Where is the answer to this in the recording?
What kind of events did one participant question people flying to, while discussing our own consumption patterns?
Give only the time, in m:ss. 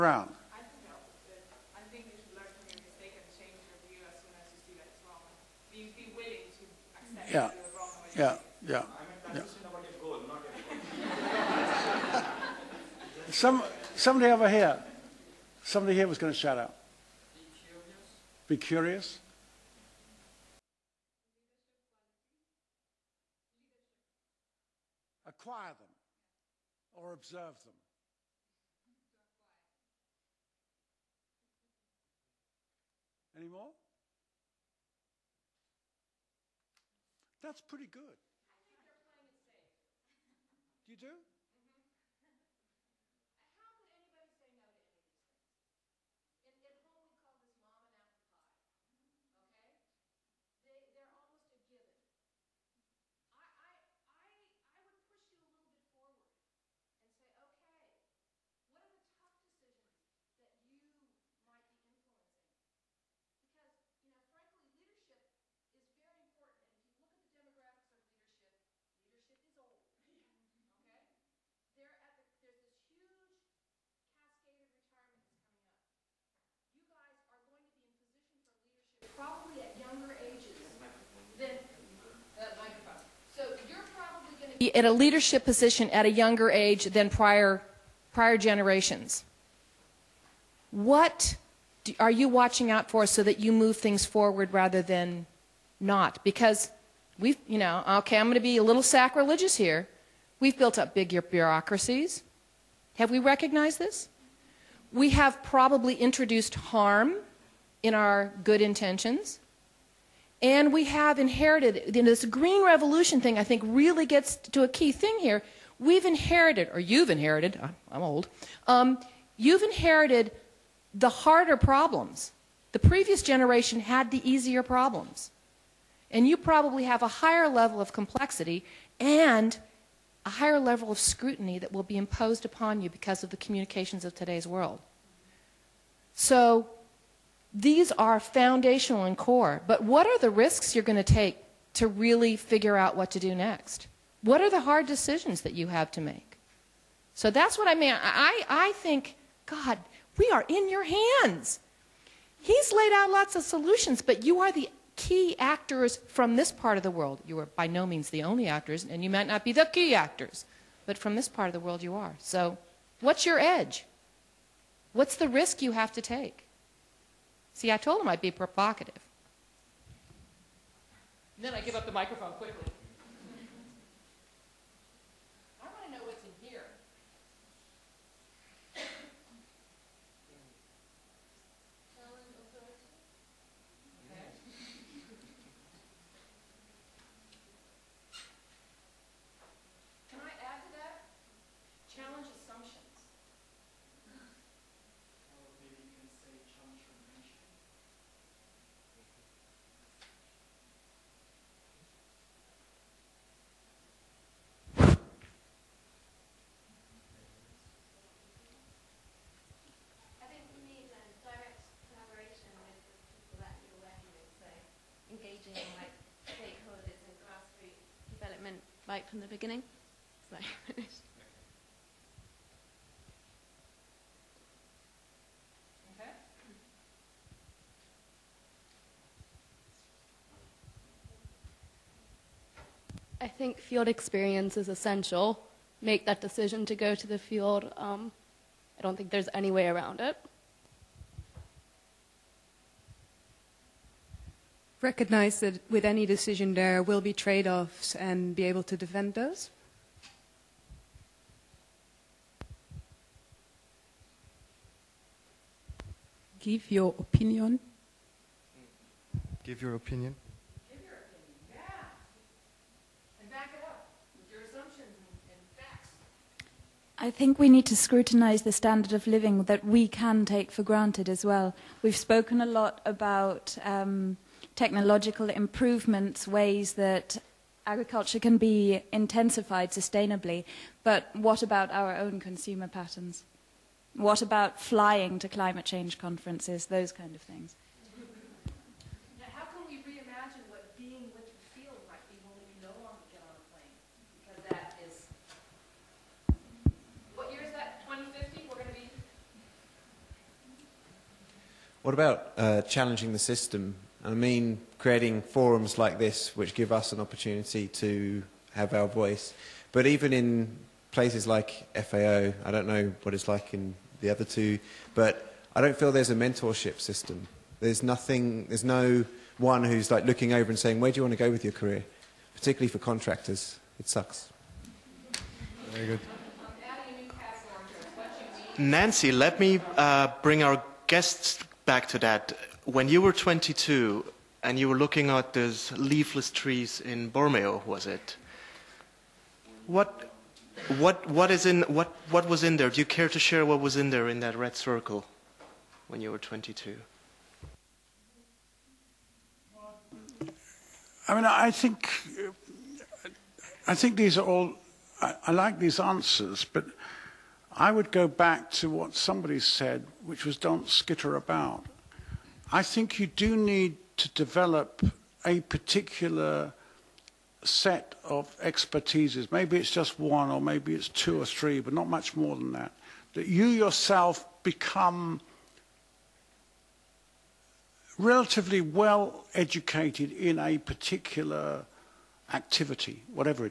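4:45.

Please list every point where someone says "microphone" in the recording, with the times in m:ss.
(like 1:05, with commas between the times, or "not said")
1:22, 2:51.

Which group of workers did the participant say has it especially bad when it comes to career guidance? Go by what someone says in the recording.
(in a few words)
contractors.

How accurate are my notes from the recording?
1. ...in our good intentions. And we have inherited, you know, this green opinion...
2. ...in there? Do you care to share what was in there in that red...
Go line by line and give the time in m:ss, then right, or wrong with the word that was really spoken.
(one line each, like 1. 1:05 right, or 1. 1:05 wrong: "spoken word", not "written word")
1. 1:47 wrong: "revolution", not "opinion"
2. 5:42 right.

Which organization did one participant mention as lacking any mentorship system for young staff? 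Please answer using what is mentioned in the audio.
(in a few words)
FAO.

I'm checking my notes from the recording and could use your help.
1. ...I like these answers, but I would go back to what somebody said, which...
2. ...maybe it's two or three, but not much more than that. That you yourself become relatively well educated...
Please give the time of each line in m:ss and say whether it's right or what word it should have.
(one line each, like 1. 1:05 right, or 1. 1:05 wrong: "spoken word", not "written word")
1. 5:55 right
2. 6:10 right.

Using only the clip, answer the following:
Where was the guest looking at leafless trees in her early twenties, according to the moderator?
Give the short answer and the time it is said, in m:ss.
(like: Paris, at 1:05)
Borneo, at 5:37.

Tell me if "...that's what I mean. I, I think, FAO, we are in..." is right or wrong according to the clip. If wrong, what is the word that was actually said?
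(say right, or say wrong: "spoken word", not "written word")
wrong: "God", not "FAO".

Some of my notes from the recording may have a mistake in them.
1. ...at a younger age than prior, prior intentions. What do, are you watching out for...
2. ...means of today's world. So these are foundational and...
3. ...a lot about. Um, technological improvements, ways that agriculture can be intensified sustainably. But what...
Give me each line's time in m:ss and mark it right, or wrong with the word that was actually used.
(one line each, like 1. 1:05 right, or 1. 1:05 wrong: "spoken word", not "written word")
1. 1:25 wrong: "generations", not "intentions"
2. 2:13 wrong: "communications", not "means"
3. 4:32 right.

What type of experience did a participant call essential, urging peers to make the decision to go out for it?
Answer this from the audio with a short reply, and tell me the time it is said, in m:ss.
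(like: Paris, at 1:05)
field experience, at 3:53.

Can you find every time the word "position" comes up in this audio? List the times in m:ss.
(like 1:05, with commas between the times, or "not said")
1:17, 1:25.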